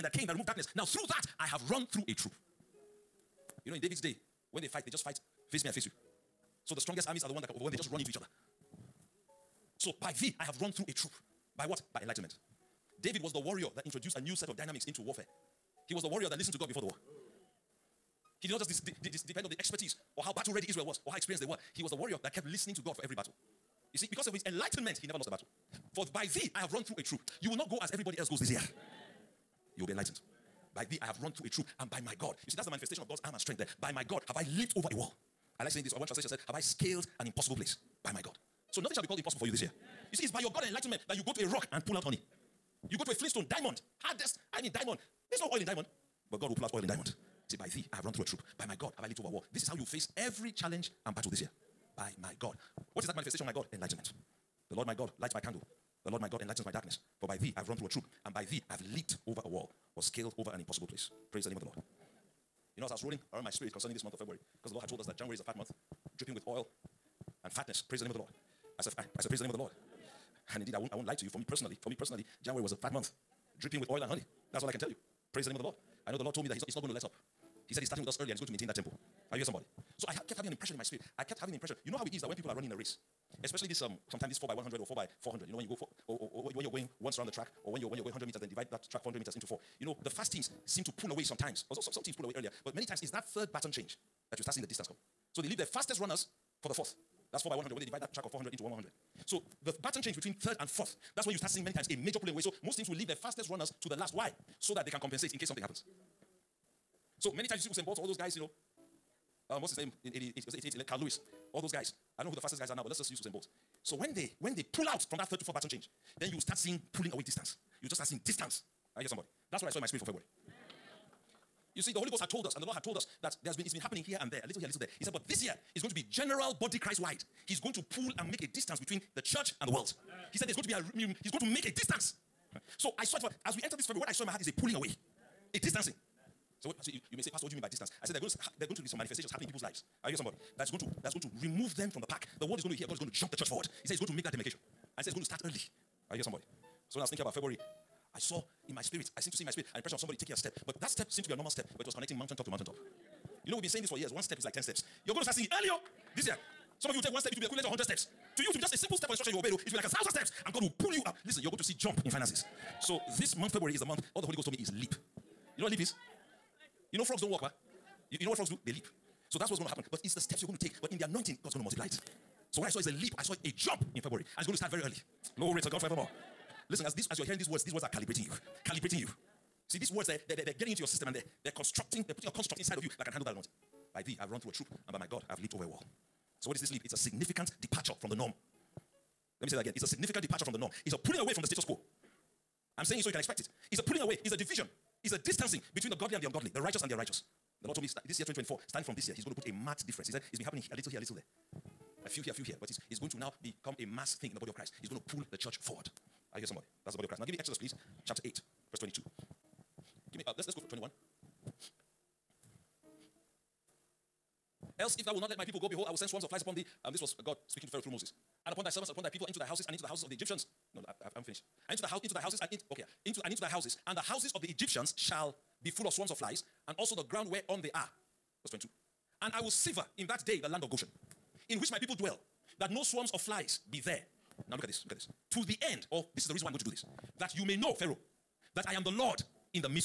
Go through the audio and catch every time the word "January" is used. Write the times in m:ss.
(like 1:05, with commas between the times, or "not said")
1:05, 1:12.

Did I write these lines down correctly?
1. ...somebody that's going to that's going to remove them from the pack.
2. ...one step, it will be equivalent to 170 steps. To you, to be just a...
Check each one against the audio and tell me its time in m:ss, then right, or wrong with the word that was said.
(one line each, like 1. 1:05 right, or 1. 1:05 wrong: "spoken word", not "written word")
1. 2:20 right
2. 2:37 wrong: "100", not "170".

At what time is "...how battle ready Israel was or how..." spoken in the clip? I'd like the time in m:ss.
0:20.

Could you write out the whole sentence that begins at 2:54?
And it's going to start very early.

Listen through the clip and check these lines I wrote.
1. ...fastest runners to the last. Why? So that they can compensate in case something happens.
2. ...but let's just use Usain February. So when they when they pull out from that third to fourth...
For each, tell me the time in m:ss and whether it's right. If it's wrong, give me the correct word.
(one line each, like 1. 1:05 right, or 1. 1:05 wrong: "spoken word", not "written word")
1. 1:43 right
2. 1:52 wrong: "Bolt", not "February".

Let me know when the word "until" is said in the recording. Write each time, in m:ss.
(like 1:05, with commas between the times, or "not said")
not said.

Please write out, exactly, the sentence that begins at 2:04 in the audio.
He said, but this year is going to be general body Christ wide.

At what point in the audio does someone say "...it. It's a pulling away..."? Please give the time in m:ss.
3:13.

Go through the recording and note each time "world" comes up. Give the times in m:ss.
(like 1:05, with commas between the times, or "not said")
2:09, 2:22.